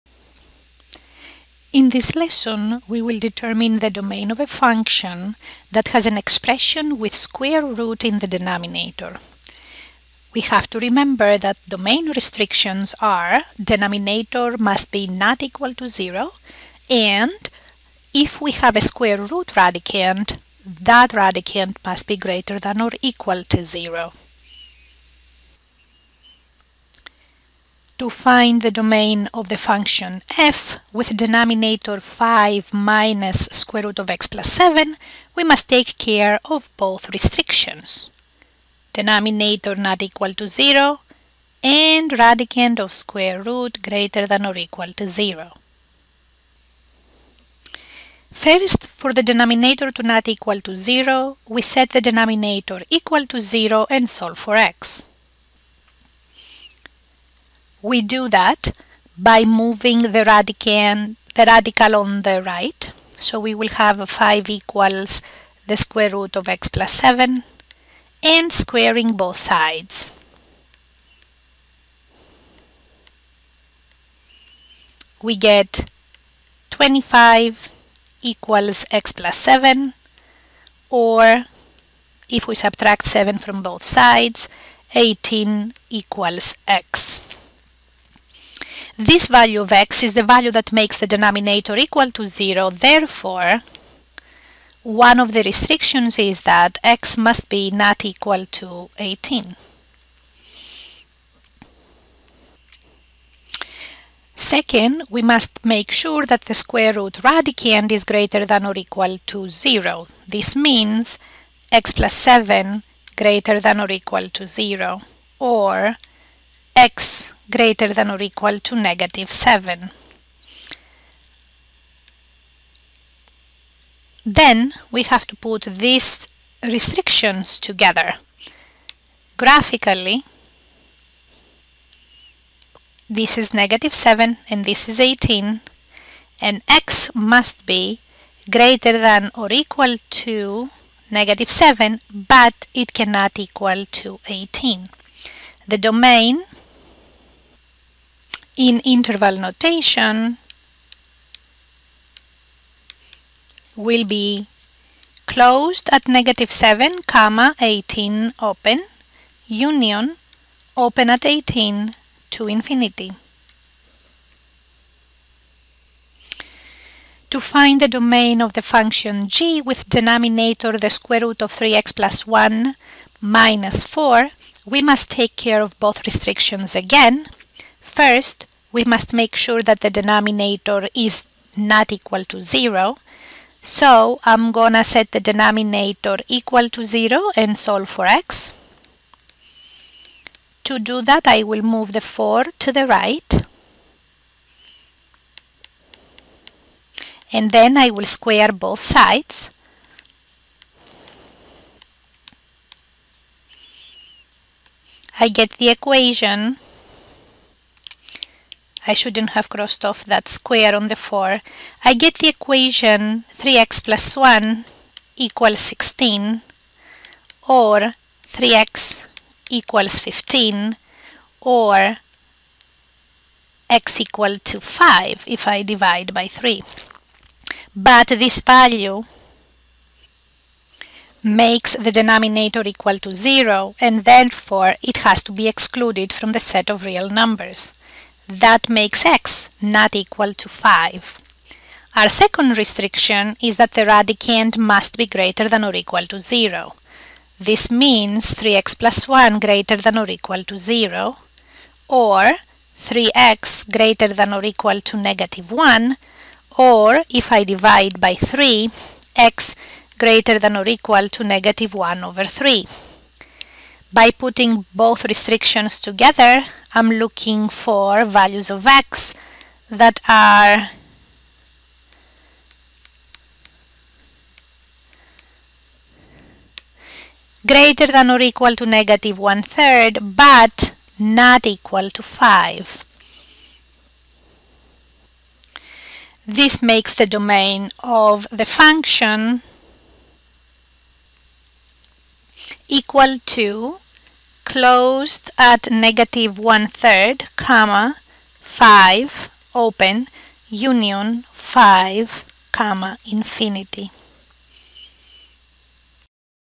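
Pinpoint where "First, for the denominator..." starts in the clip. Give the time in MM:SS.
00:48.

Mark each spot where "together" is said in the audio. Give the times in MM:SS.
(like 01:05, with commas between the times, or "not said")
02:07, 04:25.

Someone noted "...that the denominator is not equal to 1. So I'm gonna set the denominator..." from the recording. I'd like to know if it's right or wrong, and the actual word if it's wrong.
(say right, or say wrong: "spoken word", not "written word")
wrong: "0", not "1".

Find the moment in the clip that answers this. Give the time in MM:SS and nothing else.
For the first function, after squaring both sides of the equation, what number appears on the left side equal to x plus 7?
01:16.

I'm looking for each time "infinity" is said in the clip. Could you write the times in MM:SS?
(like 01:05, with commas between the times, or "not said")
02:42, 05:03.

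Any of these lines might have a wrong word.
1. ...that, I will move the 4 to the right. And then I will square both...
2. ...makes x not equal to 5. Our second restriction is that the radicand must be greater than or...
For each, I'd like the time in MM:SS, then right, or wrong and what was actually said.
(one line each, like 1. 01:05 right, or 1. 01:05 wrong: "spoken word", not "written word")
1. 03:11 right
2. 03:58 right.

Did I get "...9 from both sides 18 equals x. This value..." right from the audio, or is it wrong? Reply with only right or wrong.
wrong.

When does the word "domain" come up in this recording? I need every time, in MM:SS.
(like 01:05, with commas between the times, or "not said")
00:03, 00:11, 00:28, 02:25, 02:47, 04:47.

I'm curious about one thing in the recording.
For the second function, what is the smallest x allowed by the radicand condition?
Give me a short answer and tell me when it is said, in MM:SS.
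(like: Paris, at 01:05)
-1/3, at 04:21.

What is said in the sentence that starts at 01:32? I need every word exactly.
Therefore, one of the restrictions is that x must be not equal to 18.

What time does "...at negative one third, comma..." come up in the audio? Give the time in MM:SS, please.
04:55.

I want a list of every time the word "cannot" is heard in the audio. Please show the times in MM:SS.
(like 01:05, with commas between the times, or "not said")
02:22.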